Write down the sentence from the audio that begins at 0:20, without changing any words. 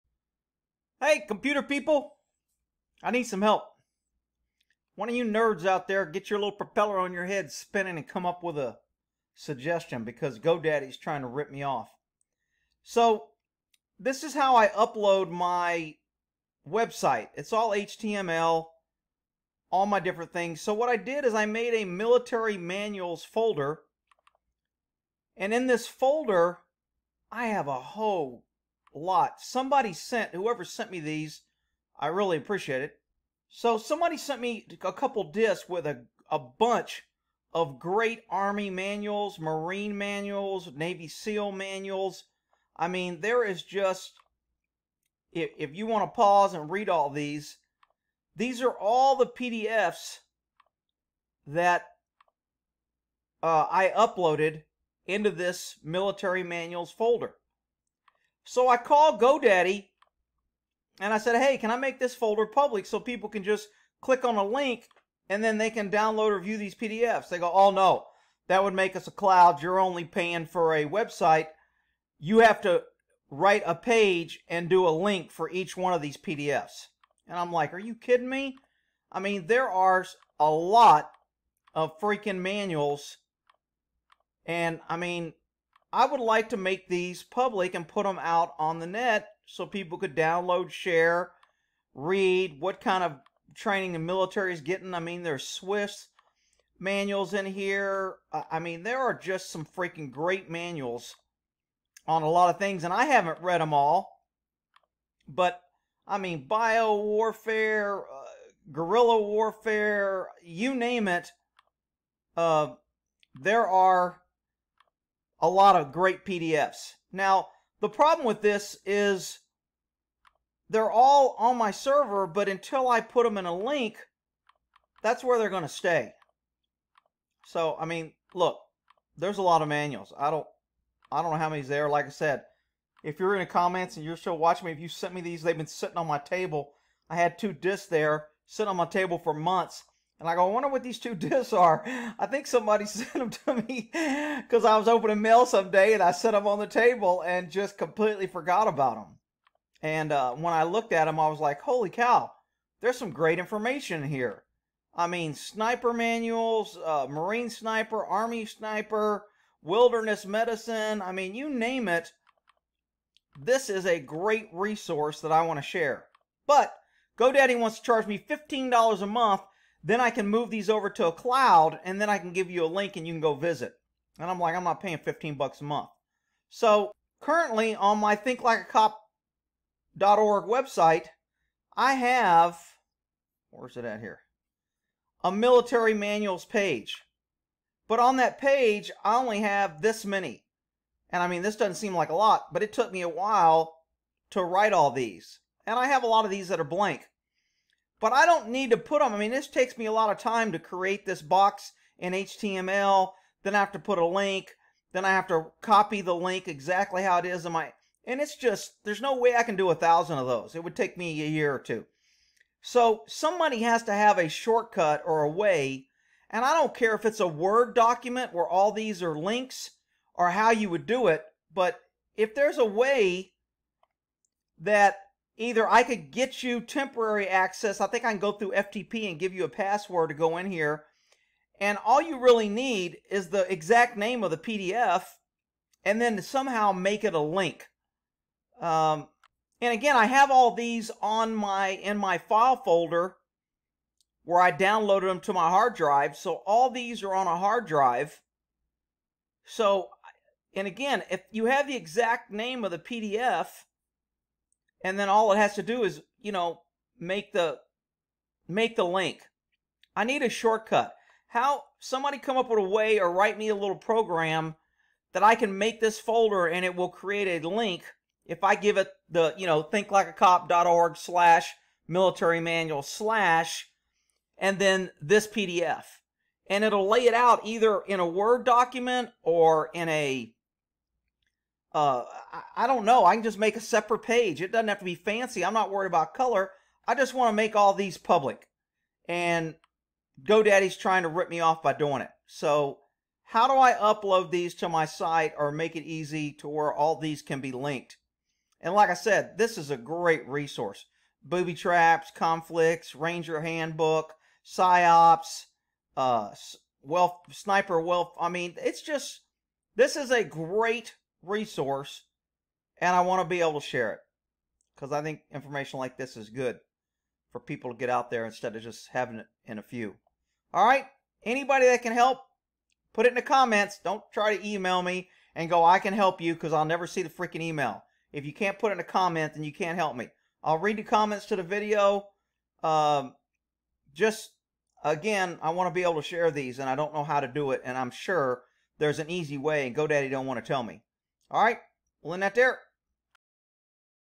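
So, what I did is I made a military manuals folder.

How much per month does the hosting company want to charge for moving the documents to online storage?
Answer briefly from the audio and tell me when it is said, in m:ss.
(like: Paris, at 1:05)
$15, at 2:48.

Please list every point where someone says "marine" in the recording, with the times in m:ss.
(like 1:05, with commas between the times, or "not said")
0:39, 2:37.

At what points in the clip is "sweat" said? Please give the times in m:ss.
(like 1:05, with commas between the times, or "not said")
not said.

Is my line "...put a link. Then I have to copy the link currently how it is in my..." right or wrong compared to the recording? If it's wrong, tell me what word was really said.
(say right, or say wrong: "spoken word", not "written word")
wrong: "exactly", not "currently".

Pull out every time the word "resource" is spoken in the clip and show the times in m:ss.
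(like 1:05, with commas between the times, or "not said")
2:44, 5:00, 5:11.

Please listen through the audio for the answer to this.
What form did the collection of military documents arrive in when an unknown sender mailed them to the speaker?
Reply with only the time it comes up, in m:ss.
0:34.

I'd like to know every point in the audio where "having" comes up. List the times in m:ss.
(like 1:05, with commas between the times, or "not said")
5:18.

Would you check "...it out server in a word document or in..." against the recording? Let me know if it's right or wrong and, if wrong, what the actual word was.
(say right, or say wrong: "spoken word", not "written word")
wrong: "either", not "server".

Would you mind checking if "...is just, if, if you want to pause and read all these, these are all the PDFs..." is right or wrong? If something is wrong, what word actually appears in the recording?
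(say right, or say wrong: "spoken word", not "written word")
right.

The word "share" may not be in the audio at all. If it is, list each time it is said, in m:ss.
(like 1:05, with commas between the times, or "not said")
1:30, 2:45, 5:13, 5:36.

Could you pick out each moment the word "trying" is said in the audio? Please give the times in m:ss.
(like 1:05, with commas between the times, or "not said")
0:10, 4:50.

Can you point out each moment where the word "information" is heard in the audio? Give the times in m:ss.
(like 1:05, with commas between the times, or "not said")
2:33, 5:15.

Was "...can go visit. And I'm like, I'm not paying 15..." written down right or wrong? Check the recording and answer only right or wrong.
right.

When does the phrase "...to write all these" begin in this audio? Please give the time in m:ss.
3:14.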